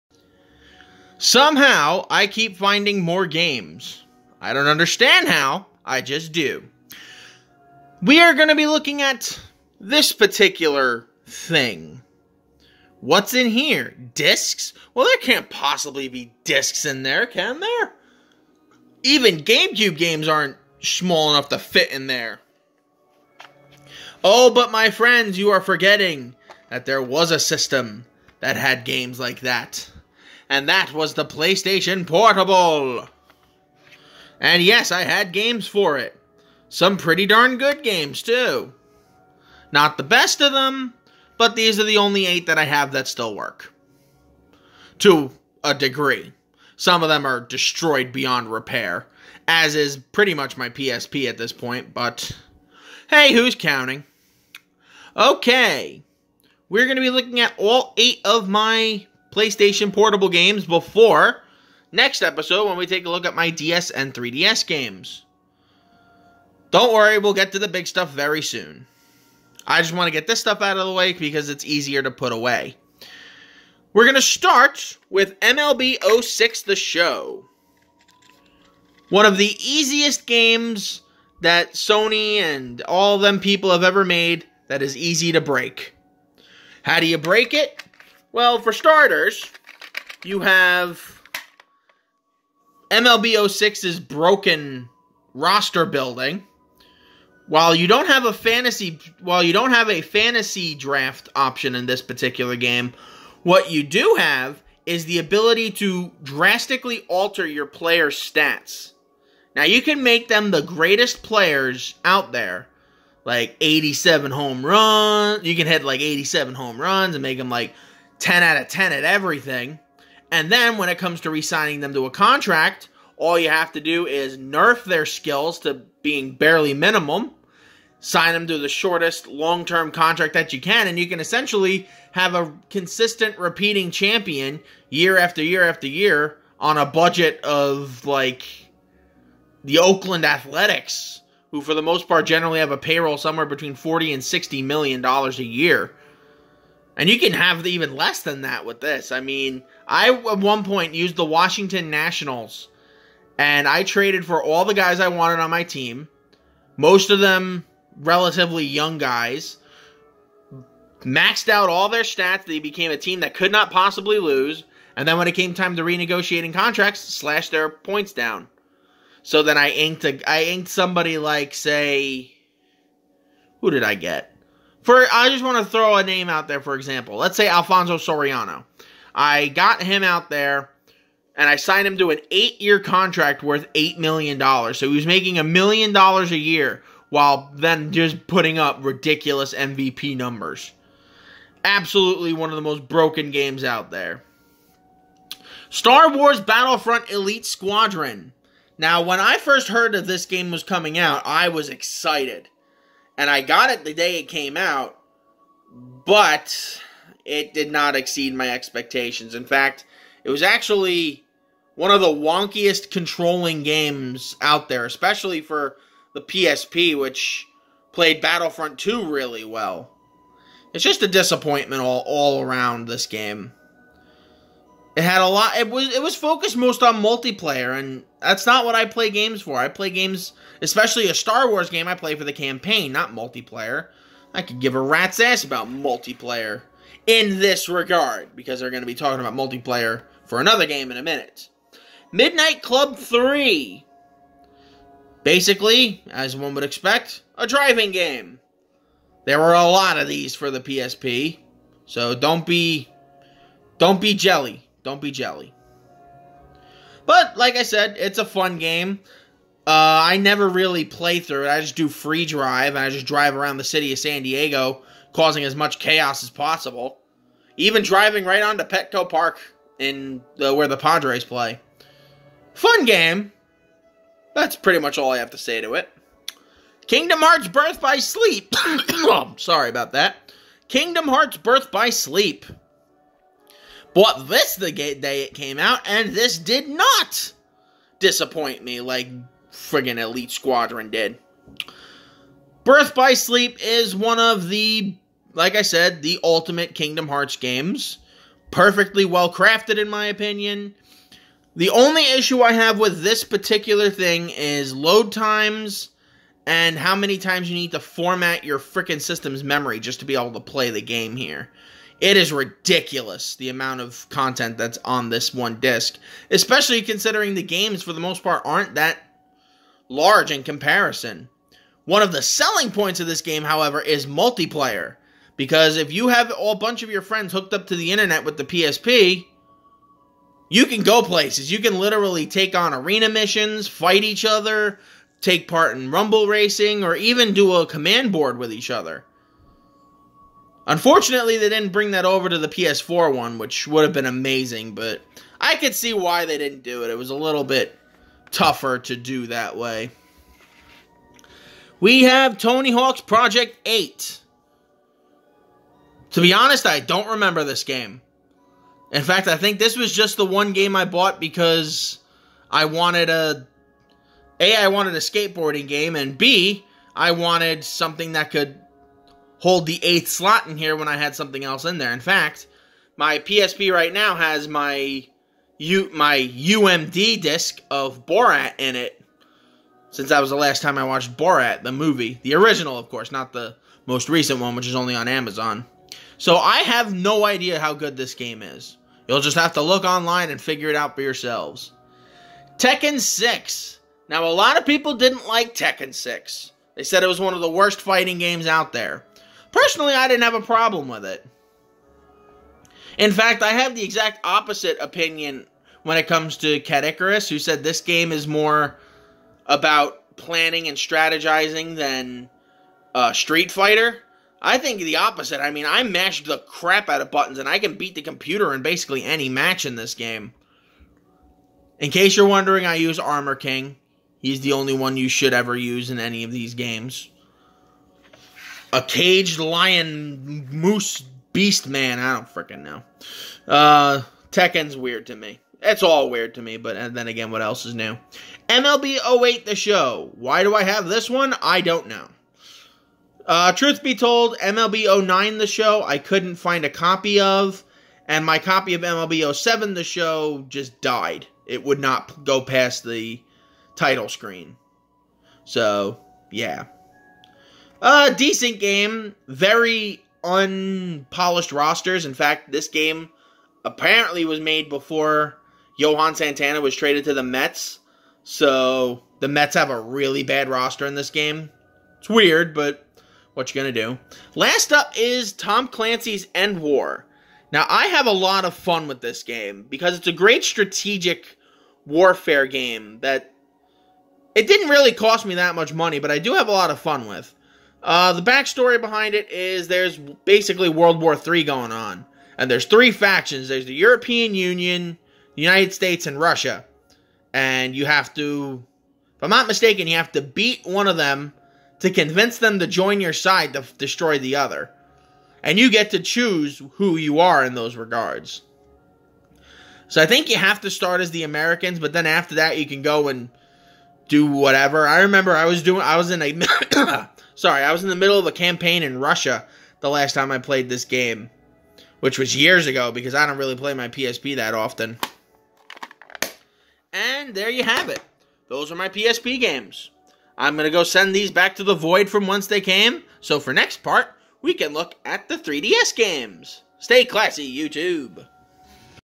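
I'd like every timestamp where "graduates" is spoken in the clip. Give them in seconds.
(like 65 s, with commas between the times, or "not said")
not said.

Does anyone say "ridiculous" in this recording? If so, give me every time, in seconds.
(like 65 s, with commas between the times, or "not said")
188 s, 312 s.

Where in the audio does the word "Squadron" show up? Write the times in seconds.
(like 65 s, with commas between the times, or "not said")
197 s, 290 s.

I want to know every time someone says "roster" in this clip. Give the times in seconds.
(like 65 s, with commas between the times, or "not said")
95 s, 461 s, 470 s.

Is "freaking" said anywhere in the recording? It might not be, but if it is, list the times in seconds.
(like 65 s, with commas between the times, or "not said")
308 s, 432 s.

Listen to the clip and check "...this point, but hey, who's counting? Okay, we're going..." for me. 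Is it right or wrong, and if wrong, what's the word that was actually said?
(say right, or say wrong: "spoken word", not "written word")
right.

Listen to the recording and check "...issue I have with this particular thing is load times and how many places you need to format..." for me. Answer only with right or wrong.
wrong.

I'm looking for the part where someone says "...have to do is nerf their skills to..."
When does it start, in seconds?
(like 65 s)
123 s.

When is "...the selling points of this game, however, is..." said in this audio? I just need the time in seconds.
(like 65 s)
322 s.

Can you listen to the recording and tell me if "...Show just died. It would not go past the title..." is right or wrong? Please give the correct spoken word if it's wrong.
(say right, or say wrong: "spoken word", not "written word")
right.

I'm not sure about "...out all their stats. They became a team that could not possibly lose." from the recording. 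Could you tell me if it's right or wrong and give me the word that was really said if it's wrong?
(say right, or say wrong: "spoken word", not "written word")
right.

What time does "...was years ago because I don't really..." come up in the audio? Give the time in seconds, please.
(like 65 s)
522 s.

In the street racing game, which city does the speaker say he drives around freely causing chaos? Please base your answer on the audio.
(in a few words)
San Diego.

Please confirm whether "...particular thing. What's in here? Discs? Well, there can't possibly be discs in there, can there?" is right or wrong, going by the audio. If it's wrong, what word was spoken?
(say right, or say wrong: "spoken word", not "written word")
right.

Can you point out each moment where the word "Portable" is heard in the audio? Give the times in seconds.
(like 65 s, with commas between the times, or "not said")
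32 s, 59 s.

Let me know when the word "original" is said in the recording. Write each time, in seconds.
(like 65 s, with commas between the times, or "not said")
382 s.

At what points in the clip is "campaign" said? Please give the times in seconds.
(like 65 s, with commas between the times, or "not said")
232 s, 518 s.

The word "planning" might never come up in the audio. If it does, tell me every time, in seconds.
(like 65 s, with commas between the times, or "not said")
410 s.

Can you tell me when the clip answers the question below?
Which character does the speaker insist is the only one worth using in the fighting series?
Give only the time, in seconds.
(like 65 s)
422 s.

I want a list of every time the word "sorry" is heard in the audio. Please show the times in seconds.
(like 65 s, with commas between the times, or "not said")
279 s, 517 s.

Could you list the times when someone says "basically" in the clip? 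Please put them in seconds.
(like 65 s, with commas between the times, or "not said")
245 s, 418 s, 489 s.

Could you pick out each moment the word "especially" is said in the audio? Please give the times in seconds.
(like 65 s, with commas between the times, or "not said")
214 s, 230 s, 316 s.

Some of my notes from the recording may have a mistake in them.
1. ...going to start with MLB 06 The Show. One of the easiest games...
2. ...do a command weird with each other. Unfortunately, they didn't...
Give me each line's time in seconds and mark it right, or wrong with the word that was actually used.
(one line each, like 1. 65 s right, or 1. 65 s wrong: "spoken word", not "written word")
1. 74 s right
2. 337 s wrong: "board", not "weird".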